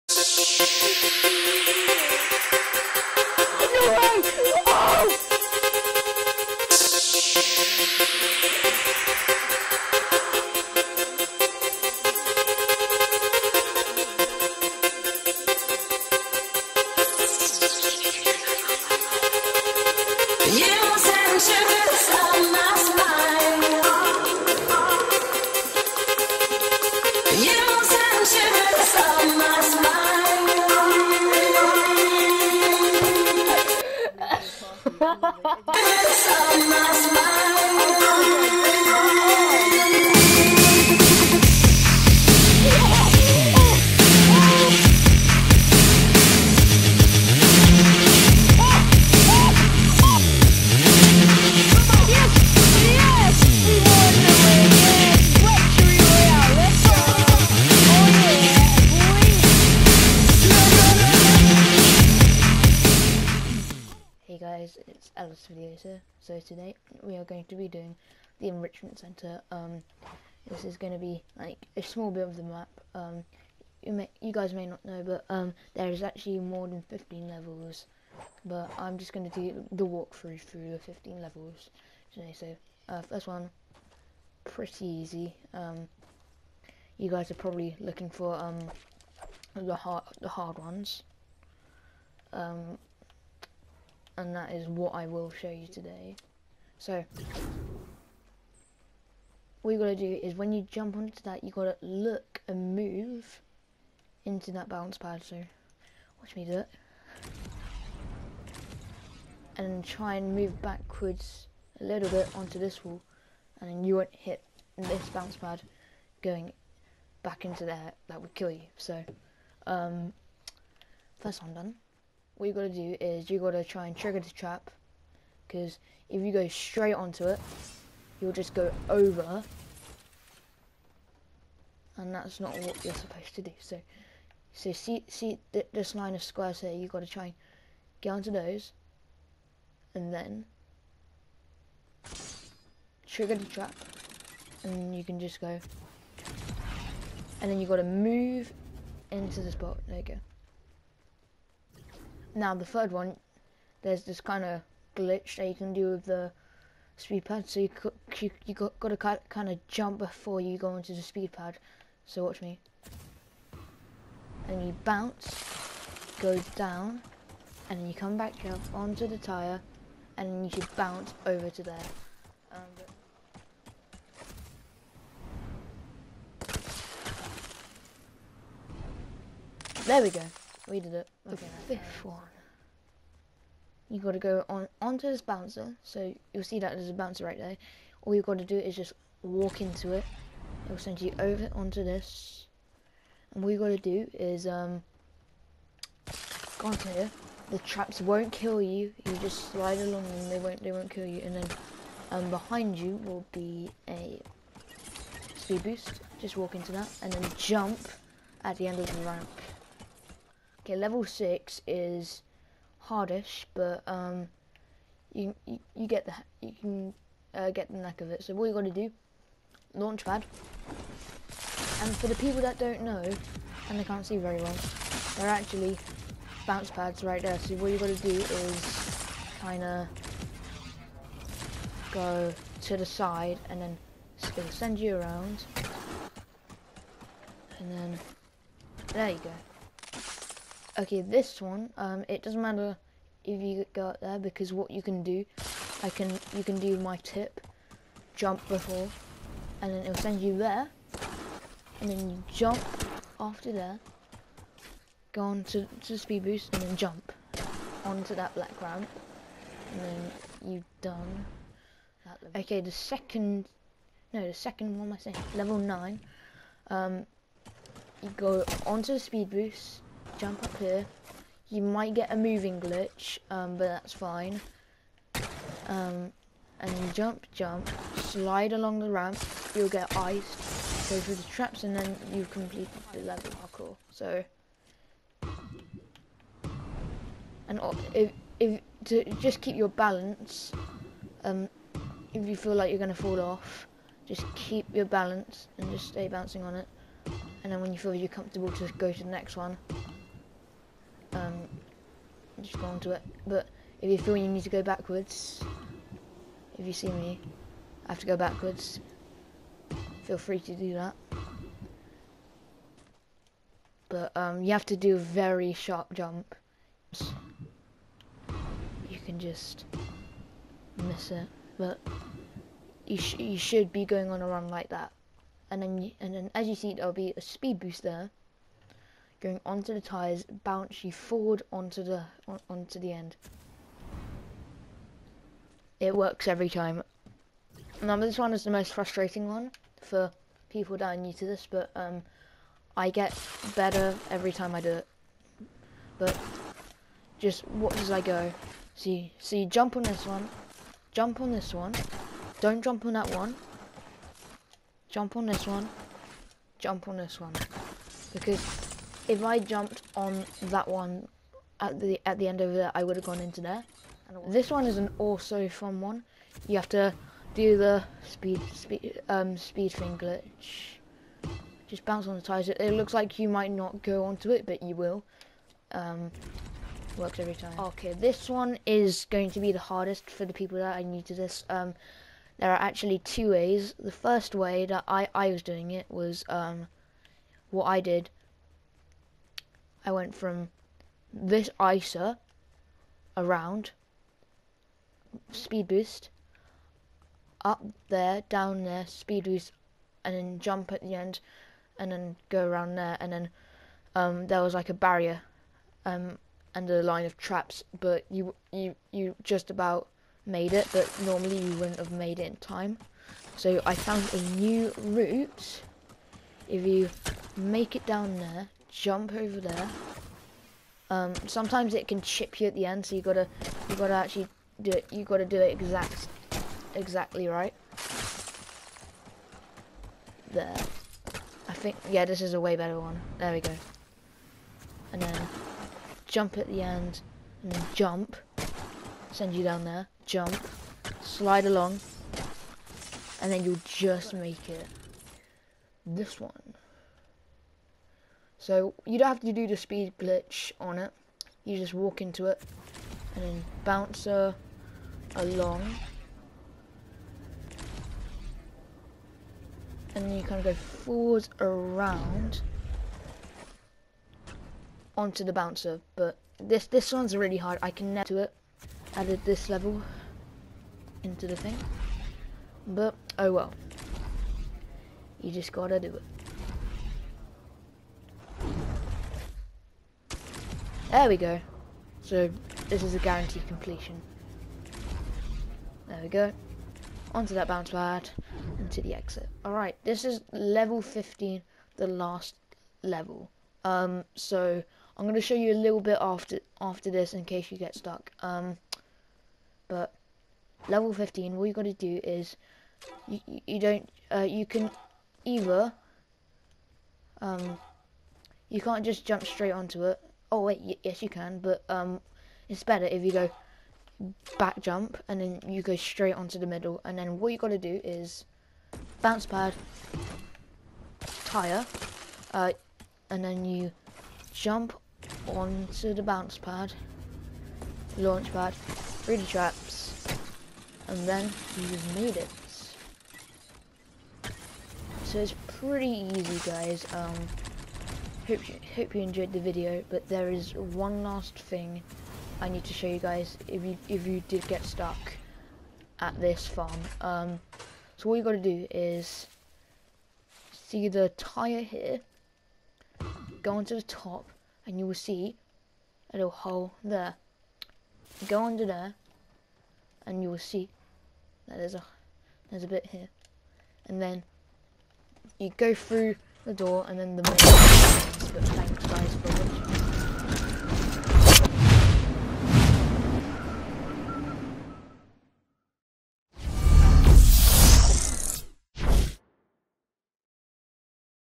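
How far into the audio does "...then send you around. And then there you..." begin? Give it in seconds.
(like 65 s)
233 s.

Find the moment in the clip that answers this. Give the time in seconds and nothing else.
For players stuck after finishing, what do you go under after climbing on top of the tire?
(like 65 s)
556 s.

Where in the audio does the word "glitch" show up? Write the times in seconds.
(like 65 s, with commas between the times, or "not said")
154 s, 272 s, 369 s, 449 s.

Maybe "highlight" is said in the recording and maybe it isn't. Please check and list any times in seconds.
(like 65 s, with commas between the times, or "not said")
not said.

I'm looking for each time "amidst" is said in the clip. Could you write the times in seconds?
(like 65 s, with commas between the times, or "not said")
not said.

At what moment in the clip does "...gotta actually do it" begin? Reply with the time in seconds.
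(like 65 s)
423 s.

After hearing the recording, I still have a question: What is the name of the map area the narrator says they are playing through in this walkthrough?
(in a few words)
Enrichment Center.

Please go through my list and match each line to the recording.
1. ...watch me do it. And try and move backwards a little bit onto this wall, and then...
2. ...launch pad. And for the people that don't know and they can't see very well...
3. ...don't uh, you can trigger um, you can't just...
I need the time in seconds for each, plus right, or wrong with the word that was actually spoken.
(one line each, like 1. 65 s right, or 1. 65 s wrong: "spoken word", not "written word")
1. 106 s right
2. 219 s right
3. 503 s wrong: "either", not "trigger".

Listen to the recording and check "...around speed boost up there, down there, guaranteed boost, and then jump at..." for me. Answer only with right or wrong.
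wrong.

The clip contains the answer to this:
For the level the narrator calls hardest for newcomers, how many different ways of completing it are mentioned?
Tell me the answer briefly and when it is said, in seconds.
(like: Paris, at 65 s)
2, at 382 s.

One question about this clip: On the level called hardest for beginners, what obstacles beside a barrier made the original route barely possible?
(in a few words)
a line of traps.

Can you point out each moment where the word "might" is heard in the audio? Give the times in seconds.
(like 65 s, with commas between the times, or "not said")
271 s, 373 s.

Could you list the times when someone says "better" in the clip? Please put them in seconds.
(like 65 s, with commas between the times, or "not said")
343 s, 432 s, 512 s.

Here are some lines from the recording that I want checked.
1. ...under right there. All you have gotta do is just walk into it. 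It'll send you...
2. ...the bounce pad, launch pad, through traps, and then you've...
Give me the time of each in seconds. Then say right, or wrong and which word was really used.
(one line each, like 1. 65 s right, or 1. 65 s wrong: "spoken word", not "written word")
1. 186 s wrong: "bouncer", not "under"
2. 525 s right.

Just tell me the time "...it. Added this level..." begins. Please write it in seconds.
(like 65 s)
468 s.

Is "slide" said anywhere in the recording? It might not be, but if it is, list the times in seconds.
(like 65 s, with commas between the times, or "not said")
199 s, 277 s, 441 s.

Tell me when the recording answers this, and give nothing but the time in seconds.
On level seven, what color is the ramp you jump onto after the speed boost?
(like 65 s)
258 s.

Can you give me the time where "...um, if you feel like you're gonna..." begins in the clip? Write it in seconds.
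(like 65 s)
291 s.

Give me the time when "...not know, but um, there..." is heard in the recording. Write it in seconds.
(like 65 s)
74 s.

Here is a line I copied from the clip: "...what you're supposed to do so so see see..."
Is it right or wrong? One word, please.
right.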